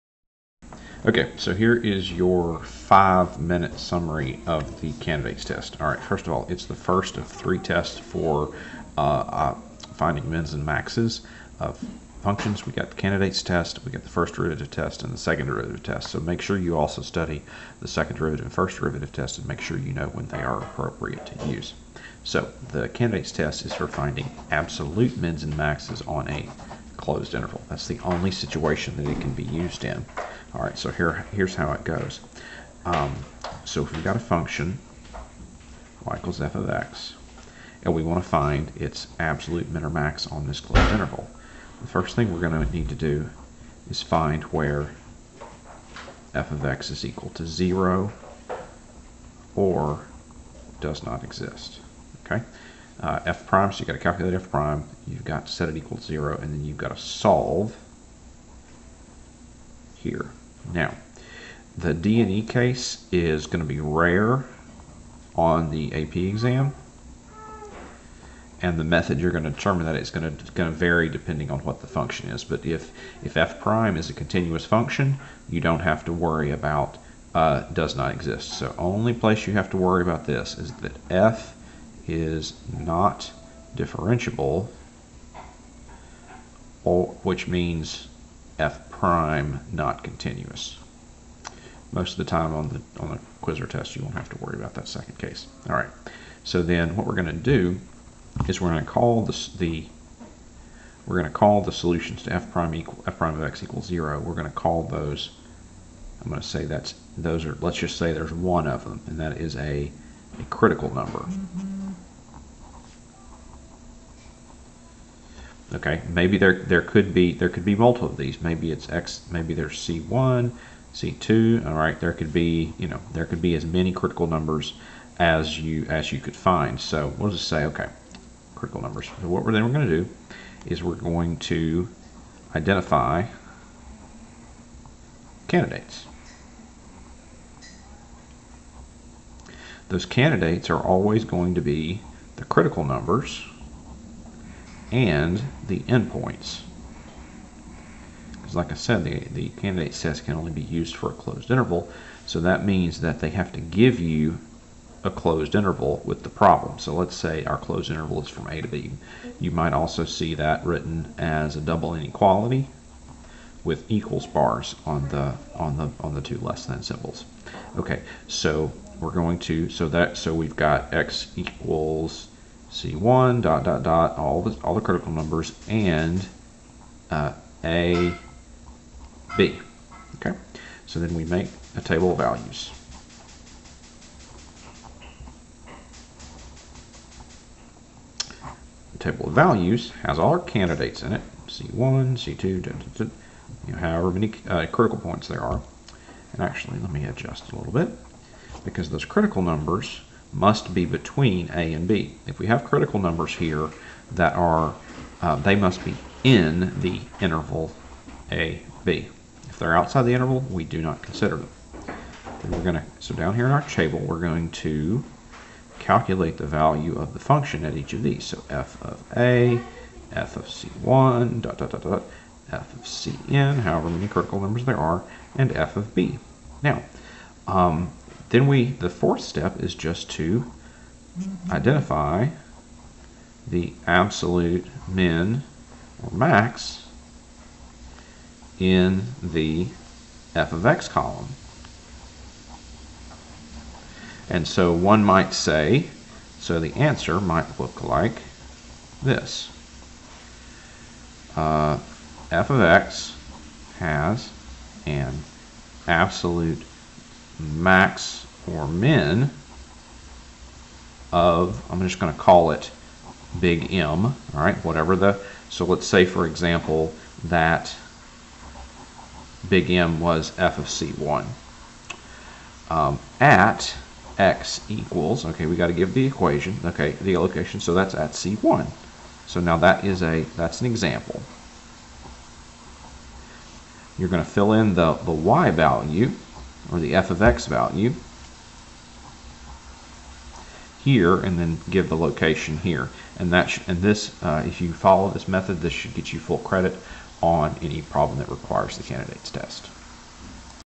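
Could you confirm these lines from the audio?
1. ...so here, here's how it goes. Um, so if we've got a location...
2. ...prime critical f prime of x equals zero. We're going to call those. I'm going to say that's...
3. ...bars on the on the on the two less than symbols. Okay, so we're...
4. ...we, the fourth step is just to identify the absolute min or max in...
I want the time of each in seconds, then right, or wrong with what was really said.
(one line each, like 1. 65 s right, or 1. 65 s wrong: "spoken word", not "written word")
1. 30 s wrong: "function", not "location"
2. 102 s wrong: "equal", not "critical"
3. 164 s right
4. 228 s right.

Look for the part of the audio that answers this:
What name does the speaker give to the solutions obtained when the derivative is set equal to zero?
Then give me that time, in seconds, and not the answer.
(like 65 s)
110 s.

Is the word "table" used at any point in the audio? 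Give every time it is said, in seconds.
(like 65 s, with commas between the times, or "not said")
181 s, 188 s, 213 s.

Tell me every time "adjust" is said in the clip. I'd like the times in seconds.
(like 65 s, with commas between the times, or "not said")
197 s.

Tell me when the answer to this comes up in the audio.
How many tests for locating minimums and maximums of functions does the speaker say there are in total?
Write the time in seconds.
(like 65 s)
7 s.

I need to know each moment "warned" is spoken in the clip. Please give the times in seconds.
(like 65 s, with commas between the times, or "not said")
not said.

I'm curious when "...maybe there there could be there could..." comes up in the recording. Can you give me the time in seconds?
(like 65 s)
116 s.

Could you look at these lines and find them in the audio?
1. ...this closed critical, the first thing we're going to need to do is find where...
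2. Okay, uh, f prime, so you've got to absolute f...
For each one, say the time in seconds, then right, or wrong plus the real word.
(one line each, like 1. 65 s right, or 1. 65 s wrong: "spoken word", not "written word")
1. 40 s wrong: "interval", not "critical"
2. 52 s wrong: "calculate", not "absolute".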